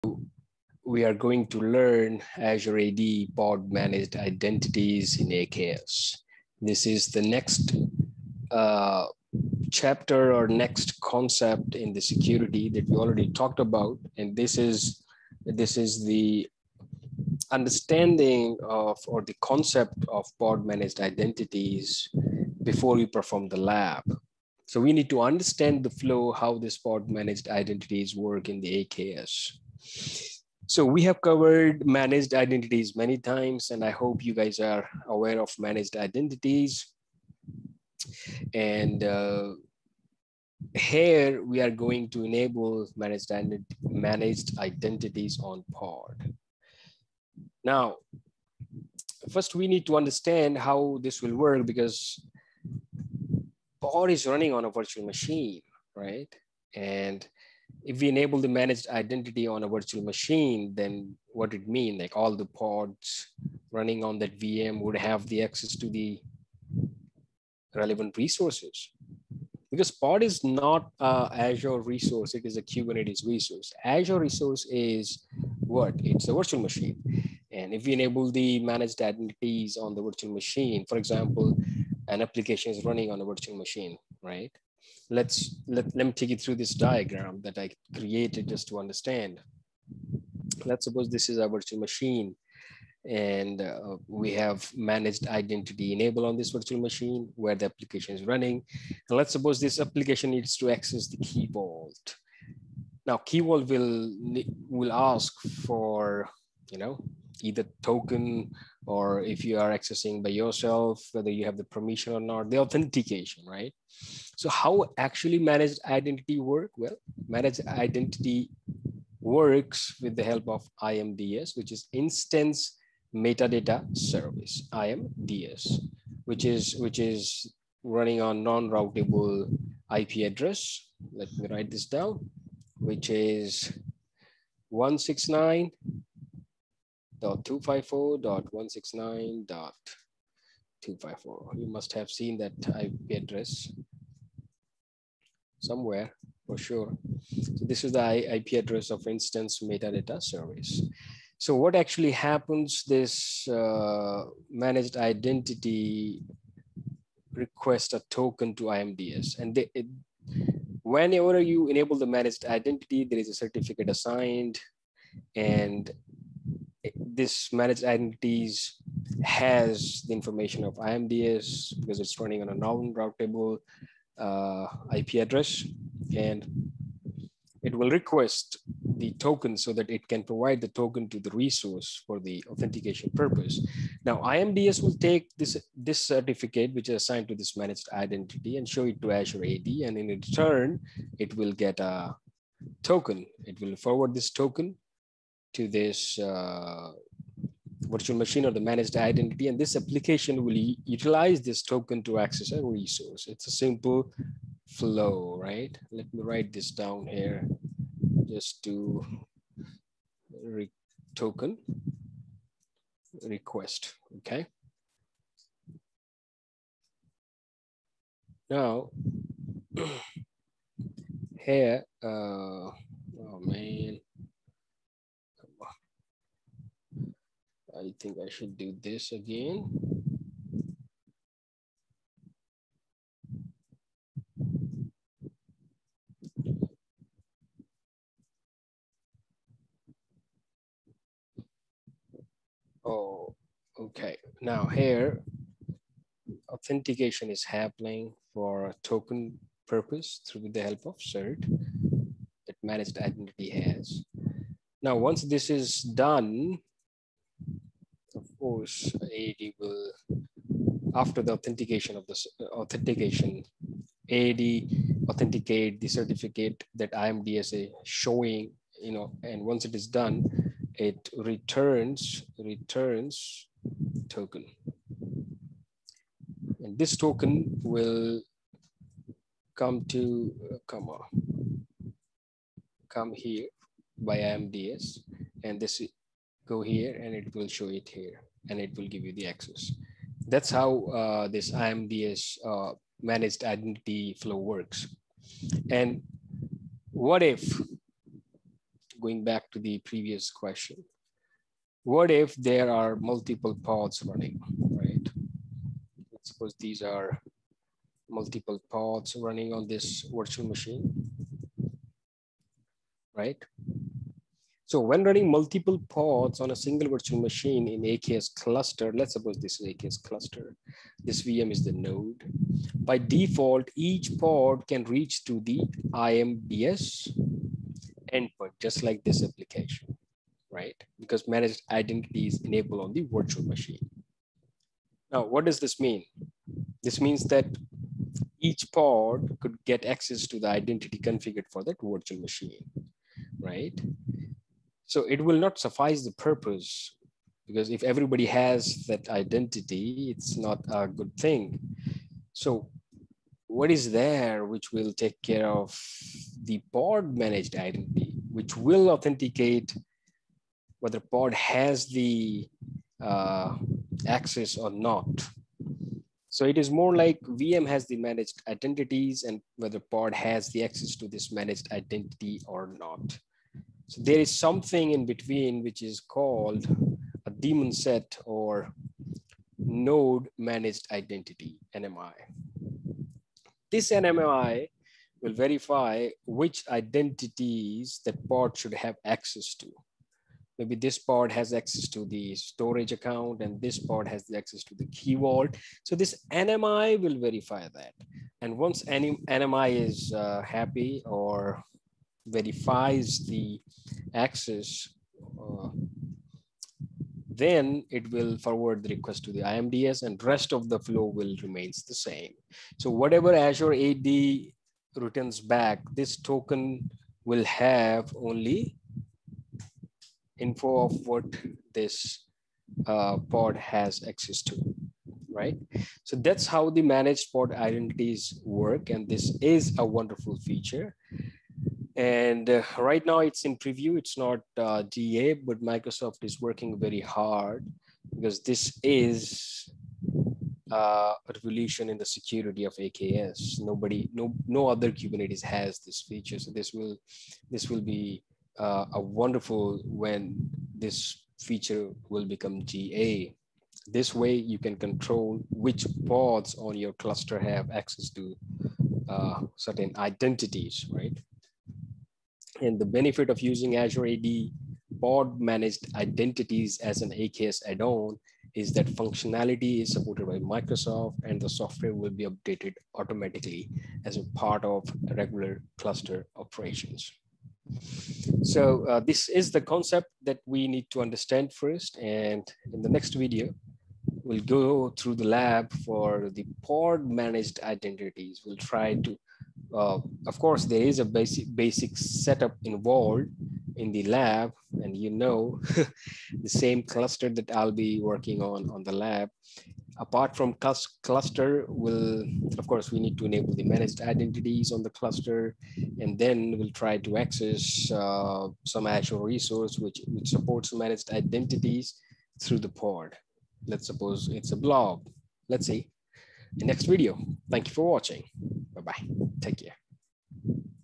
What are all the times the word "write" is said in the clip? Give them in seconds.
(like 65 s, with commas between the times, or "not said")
131 s, 206 s.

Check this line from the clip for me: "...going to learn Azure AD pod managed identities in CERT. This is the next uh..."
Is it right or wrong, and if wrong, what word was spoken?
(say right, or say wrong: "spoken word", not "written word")
wrong: "AKS", not "CERT".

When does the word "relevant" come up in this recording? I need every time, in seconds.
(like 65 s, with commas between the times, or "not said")
67 s.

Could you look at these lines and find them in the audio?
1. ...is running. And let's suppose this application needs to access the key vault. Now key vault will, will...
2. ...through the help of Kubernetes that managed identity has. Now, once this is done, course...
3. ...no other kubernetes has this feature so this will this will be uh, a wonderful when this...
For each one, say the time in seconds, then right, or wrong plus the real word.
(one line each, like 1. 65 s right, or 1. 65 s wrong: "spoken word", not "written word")
1. 98 s right
2. 250 s wrong: "CERT", not "Kubernetes"
3. 444 s right.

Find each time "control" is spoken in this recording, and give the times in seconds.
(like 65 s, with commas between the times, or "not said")
454 s.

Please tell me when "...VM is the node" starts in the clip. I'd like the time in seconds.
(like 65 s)
321 s.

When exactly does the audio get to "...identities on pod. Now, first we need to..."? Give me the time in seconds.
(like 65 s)
44 s.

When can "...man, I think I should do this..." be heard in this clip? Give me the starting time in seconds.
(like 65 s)
223 s.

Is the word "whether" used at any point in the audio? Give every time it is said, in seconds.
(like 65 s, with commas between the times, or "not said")
111 s, 360 s, 369 s.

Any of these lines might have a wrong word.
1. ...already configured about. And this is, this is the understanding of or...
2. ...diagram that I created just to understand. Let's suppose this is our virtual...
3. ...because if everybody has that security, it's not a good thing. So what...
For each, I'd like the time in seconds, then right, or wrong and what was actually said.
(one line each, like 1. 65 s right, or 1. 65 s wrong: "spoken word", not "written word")
1. 12 s wrong: "talked", not "configured"
2. 86 s right
3. 347 s wrong: "identity", not "security".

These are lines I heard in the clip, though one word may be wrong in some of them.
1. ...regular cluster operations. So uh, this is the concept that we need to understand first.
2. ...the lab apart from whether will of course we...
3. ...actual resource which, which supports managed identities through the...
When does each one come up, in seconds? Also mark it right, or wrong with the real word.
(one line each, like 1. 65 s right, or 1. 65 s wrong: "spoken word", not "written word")
1. 475 s right
2. 498 s wrong: "cluster", not "whether"
3. 508 s right.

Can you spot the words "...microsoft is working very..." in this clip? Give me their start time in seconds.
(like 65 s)
435 s.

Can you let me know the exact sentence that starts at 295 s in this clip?
And what if, going back to the previous question, what if there are multiple pods running, right?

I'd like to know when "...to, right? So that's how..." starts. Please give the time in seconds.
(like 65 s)
424 s.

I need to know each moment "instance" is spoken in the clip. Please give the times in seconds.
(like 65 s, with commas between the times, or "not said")
121 s, 149 s.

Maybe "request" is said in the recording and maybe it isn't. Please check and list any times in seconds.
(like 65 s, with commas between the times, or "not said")
157 s, 177 s, 213 s, 408 s.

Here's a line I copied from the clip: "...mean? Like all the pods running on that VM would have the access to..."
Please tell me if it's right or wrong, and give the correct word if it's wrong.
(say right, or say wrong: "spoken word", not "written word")
right.